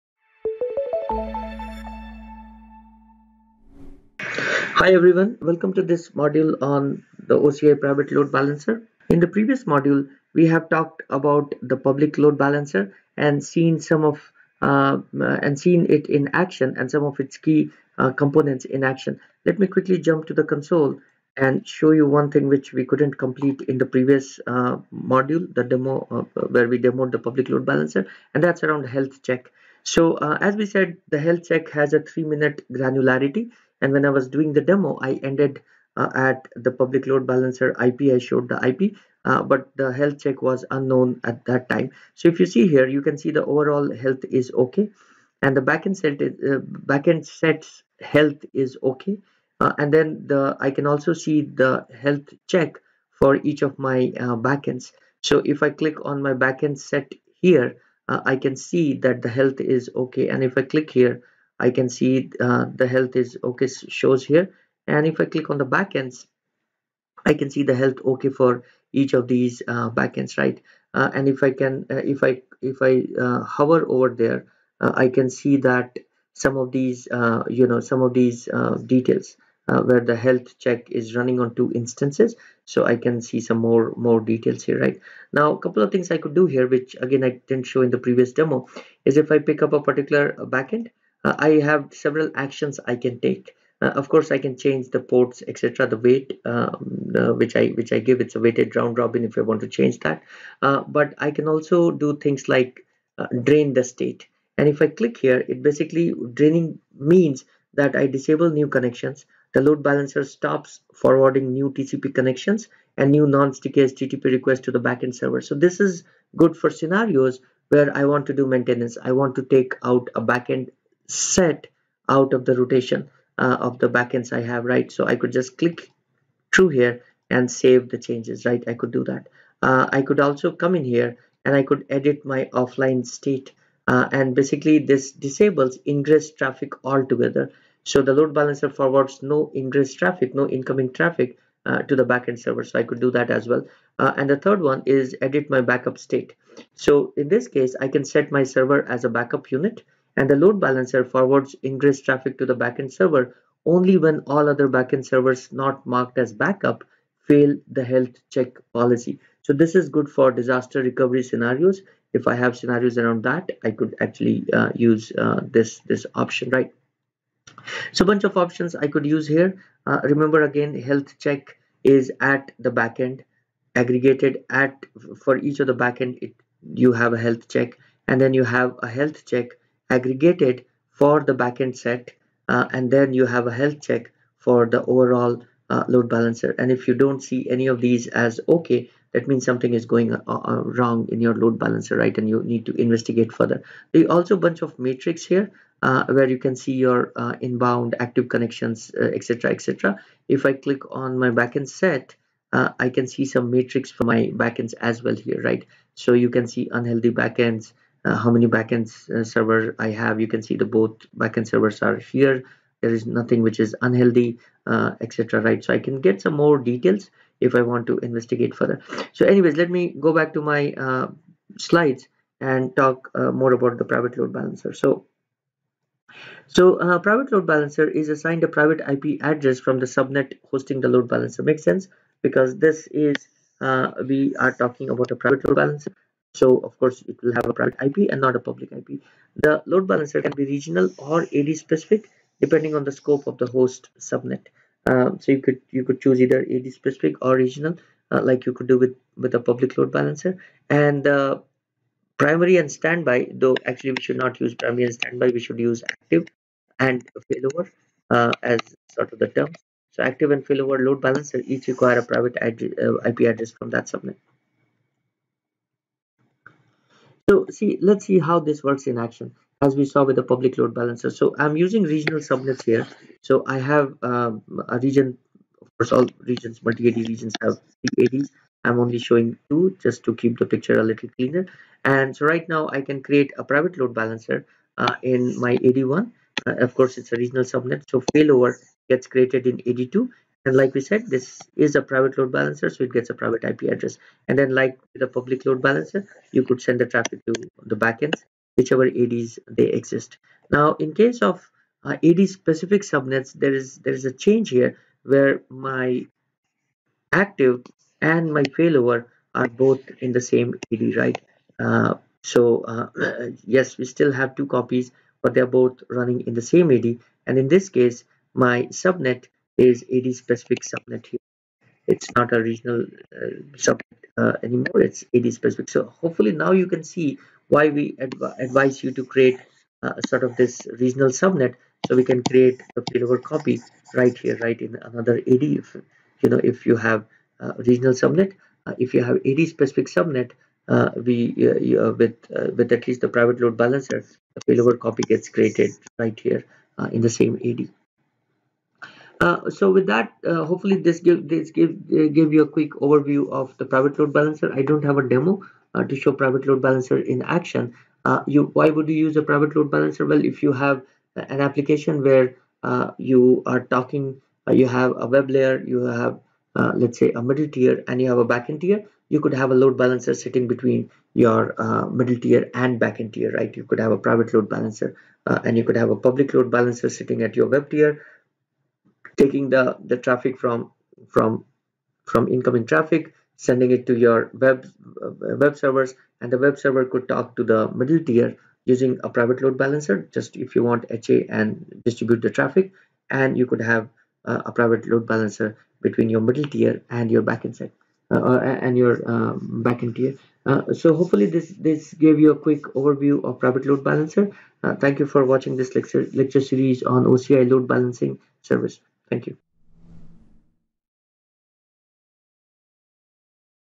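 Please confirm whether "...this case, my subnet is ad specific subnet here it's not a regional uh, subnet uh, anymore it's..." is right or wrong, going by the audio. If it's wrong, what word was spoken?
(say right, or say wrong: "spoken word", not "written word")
right.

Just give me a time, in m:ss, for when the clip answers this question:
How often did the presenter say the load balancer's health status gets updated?
0:31.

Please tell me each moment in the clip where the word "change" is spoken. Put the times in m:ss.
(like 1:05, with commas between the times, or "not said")
1:34, 1:39, 2:07, 5:04.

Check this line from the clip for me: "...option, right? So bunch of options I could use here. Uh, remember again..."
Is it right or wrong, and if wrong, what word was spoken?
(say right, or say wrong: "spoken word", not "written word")
right.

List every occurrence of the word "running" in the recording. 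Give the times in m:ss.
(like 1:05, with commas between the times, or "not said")
1:21, 5:15.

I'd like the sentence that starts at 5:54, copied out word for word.
I don't have a demo uh, to show private load balancer in action.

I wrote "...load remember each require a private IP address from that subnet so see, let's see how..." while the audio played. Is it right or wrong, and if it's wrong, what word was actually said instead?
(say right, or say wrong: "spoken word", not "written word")
wrong: "balancer", not "remember".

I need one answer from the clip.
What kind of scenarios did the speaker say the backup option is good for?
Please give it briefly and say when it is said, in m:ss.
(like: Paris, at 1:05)
disaster recovery, at 2:40.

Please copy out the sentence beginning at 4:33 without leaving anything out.
So I have um, a region, of course, all regions, multi-AD regions have three ADs.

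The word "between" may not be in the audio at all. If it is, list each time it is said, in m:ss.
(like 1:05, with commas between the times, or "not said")
6:10, 6:35.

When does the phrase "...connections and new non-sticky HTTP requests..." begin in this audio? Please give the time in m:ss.
1:52.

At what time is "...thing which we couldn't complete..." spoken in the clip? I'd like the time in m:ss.
0:22.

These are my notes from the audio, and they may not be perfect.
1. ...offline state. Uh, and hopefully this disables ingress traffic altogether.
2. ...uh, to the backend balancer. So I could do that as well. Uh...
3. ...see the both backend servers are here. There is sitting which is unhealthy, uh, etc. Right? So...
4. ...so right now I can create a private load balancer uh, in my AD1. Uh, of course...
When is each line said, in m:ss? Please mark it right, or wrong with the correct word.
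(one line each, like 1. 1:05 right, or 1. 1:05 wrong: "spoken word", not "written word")
1. 2:12 wrong: "basically", not "hopefully"
2. 2:21 wrong: "server", not "balancer"
3. 3:30 wrong: "nothing", not "sitting"
4. 4:42 right.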